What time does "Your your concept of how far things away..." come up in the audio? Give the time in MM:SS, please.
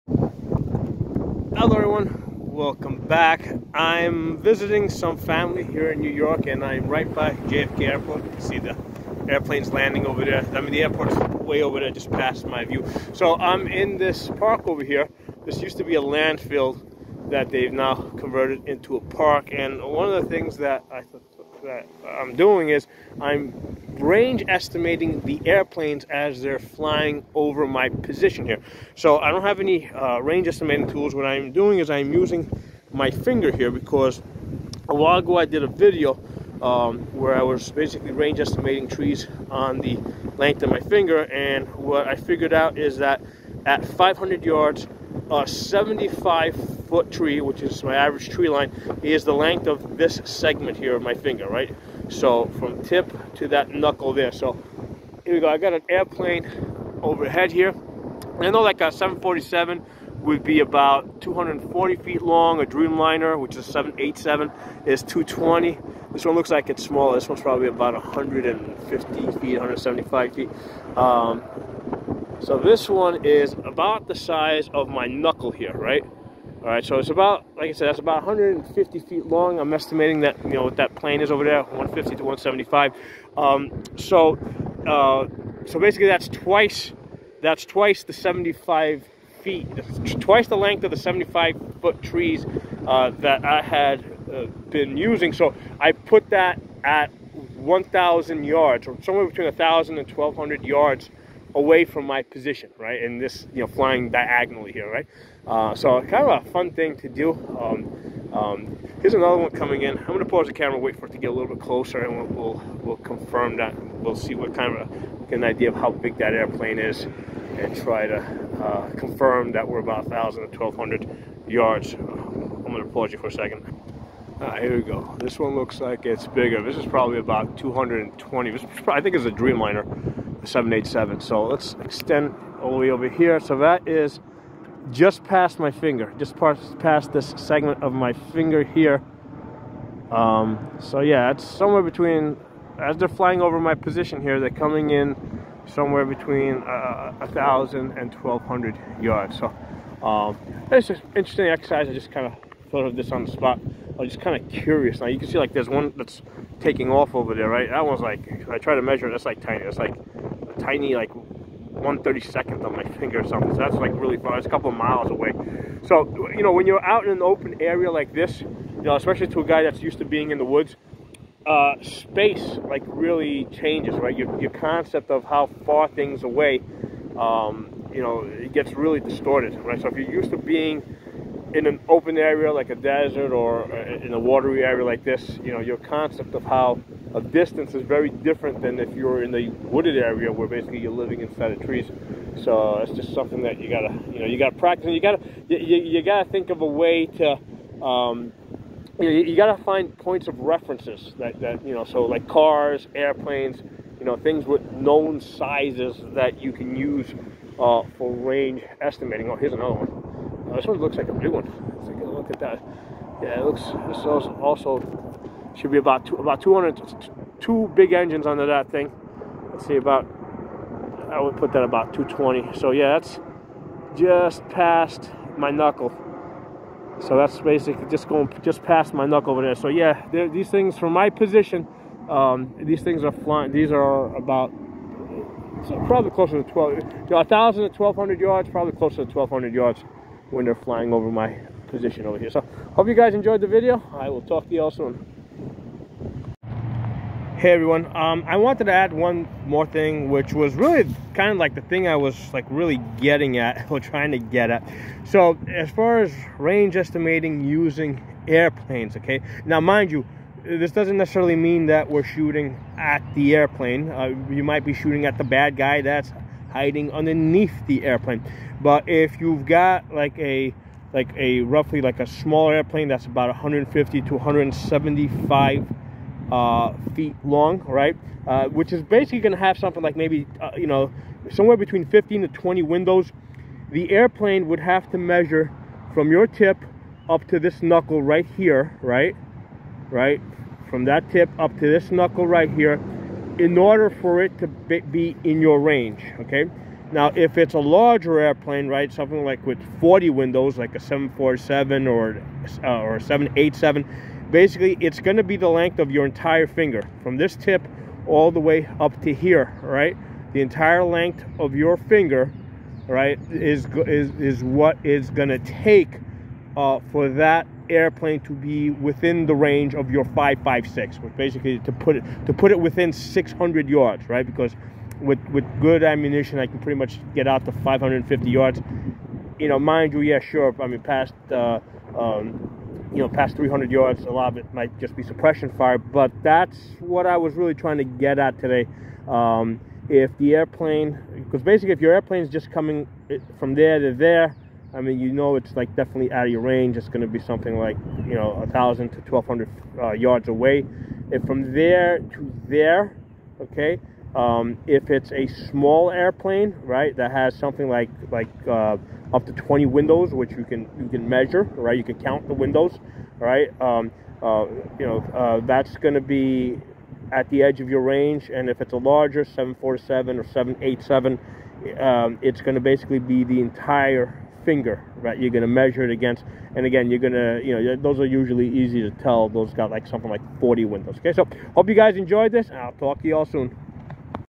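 02:54.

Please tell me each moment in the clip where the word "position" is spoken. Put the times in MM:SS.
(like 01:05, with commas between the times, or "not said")
00:27, 01:42, 02:23, 03:51, 04:01.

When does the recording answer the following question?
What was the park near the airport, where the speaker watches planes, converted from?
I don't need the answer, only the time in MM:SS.
00:16.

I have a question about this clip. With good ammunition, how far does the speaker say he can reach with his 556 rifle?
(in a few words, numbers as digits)
550 yards.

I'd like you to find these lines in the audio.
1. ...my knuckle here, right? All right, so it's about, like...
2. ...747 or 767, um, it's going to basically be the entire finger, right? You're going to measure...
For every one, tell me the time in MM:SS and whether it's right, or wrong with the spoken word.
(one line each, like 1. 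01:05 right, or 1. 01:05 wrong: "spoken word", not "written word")
1. 01:14 right
2. 06:09 wrong: "787", not "767".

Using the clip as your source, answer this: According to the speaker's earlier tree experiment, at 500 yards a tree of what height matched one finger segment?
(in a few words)
75 foot.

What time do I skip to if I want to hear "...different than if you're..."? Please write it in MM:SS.
03:08.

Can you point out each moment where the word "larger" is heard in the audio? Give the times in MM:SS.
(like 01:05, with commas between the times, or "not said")
04:57, 06:08.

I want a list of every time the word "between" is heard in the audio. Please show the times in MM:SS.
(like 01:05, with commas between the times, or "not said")
01:39, 02:21, 02:26, 04:41.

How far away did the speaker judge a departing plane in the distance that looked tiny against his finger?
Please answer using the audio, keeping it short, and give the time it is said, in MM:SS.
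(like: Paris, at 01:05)
a couple of miles, at 02:44.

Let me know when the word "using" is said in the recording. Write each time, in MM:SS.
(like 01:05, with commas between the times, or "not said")
00:32, 01:34, 04:17.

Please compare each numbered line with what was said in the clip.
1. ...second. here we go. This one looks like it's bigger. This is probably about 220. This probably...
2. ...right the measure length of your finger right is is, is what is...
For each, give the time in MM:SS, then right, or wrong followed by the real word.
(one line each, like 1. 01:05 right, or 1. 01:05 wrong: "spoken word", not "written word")
1. 02:03 right
2. 05:09 wrong: "entire", not "measure".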